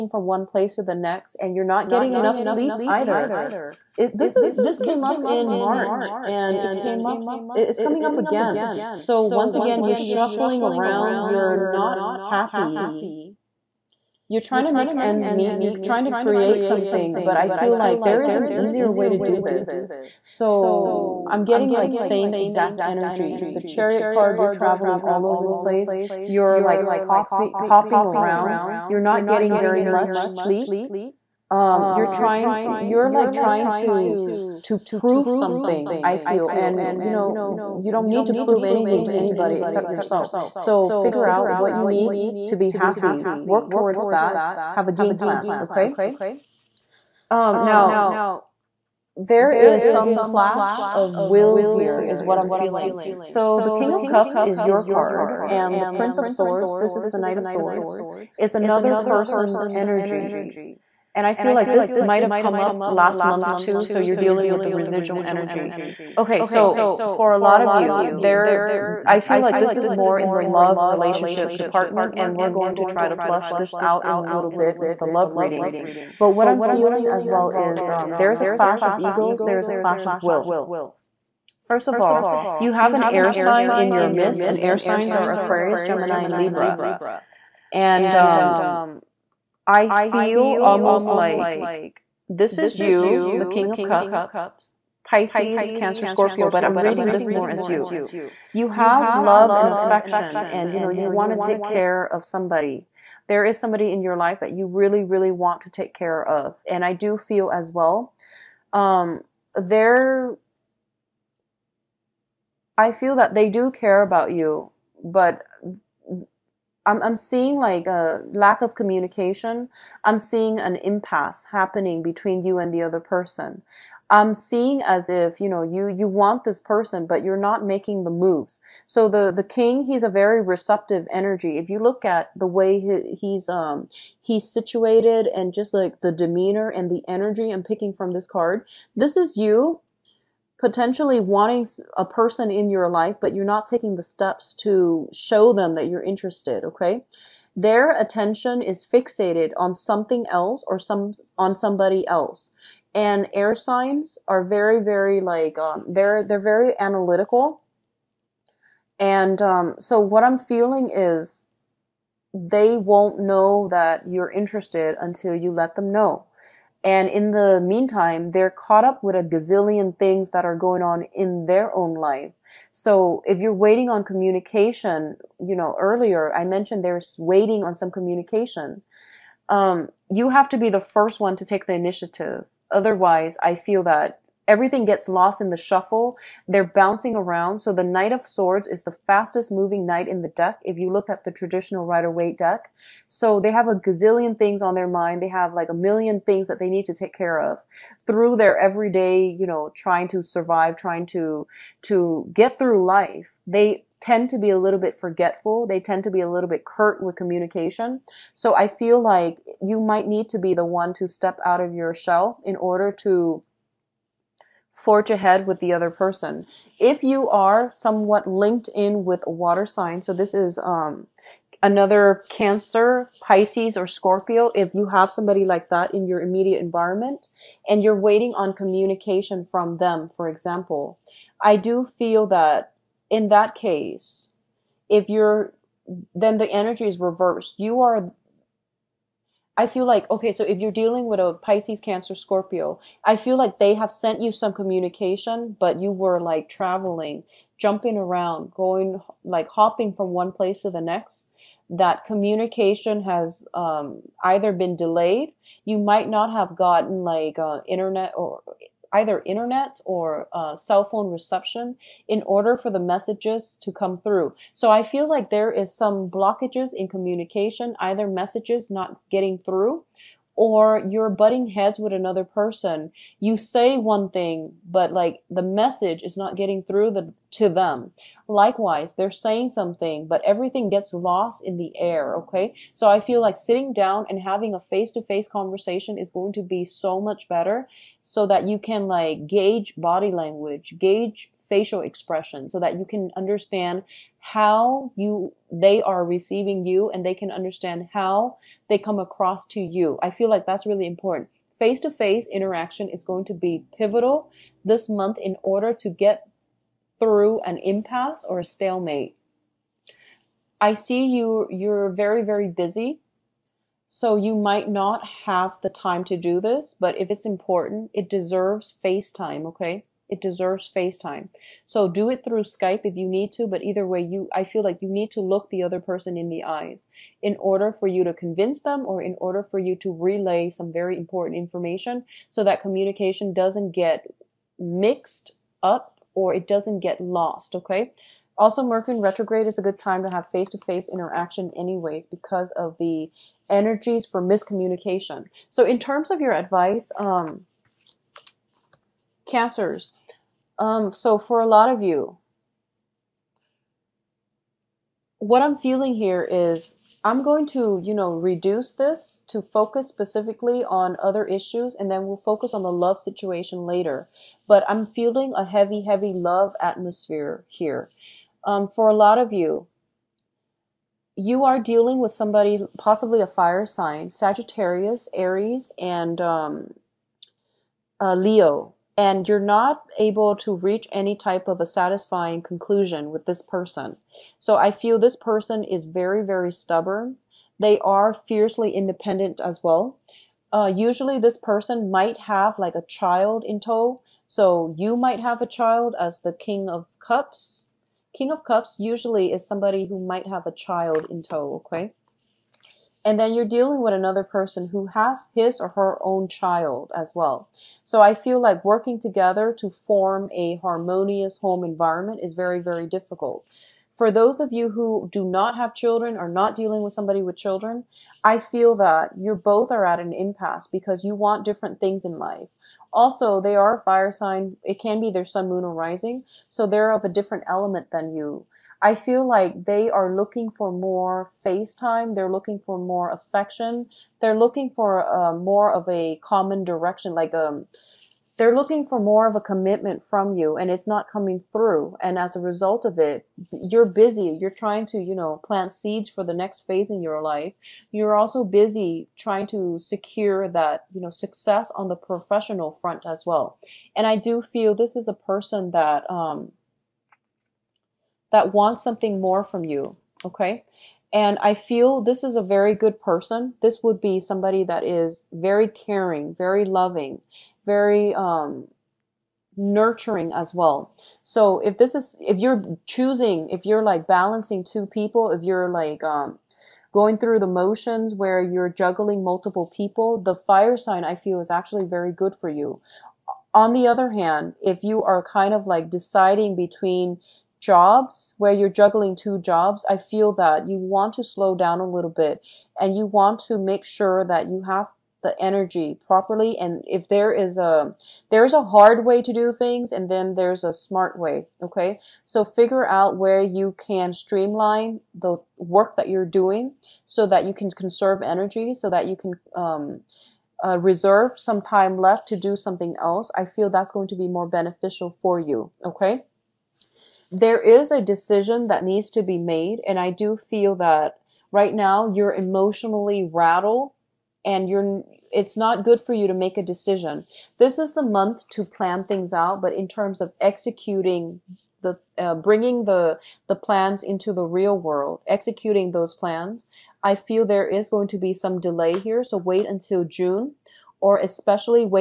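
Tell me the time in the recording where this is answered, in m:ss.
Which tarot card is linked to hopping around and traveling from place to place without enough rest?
0:23.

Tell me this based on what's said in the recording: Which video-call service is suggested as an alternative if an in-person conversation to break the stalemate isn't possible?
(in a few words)
Skype.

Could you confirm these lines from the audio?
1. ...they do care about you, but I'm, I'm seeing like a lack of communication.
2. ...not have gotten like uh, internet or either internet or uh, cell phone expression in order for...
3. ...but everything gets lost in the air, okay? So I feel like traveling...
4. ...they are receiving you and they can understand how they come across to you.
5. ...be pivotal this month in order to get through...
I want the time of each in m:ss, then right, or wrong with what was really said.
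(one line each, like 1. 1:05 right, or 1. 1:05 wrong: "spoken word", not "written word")
1. 1:53 right
2. 4:16 wrong: "reception", not "expression"
3. 4:40 wrong: "sitting", not "traveling"
4. 4:55 right
5. 5:03 right.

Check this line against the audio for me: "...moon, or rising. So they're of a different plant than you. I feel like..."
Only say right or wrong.
wrong.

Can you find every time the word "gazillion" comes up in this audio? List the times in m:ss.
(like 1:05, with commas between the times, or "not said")
2:49, 3:13.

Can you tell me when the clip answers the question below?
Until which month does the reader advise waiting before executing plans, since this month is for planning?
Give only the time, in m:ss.
9:00.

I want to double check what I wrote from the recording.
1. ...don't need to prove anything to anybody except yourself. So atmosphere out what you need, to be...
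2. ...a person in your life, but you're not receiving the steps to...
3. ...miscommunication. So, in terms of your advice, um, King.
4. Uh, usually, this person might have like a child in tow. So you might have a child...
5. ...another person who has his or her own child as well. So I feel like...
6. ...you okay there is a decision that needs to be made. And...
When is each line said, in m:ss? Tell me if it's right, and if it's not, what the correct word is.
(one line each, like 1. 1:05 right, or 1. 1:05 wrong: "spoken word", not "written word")
1. 0:37 wrong: "figure", not "atmosphere"
2. 2:21 wrong: "taking", not "receiving"
3. 5:44 wrong: "Cancers", not "King"
4. 6:30 right
5. 6:43 right
6. 8:35 right.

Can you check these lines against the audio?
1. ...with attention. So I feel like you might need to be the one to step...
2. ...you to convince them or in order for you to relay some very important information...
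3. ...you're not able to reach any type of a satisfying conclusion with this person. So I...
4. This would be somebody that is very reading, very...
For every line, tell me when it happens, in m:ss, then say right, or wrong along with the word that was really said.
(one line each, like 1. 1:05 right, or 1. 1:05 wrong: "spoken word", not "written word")
1. 3:27 wrong: "communication", not "attention"
2. 5:27 right
3. 6:19 right
4. 7:43 wrong: "caring", not "reading".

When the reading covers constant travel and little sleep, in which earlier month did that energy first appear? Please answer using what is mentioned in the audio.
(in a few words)
March.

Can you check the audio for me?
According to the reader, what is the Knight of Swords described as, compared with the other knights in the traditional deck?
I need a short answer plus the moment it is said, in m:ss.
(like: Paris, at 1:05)
the fastest moving knight, at 3:08.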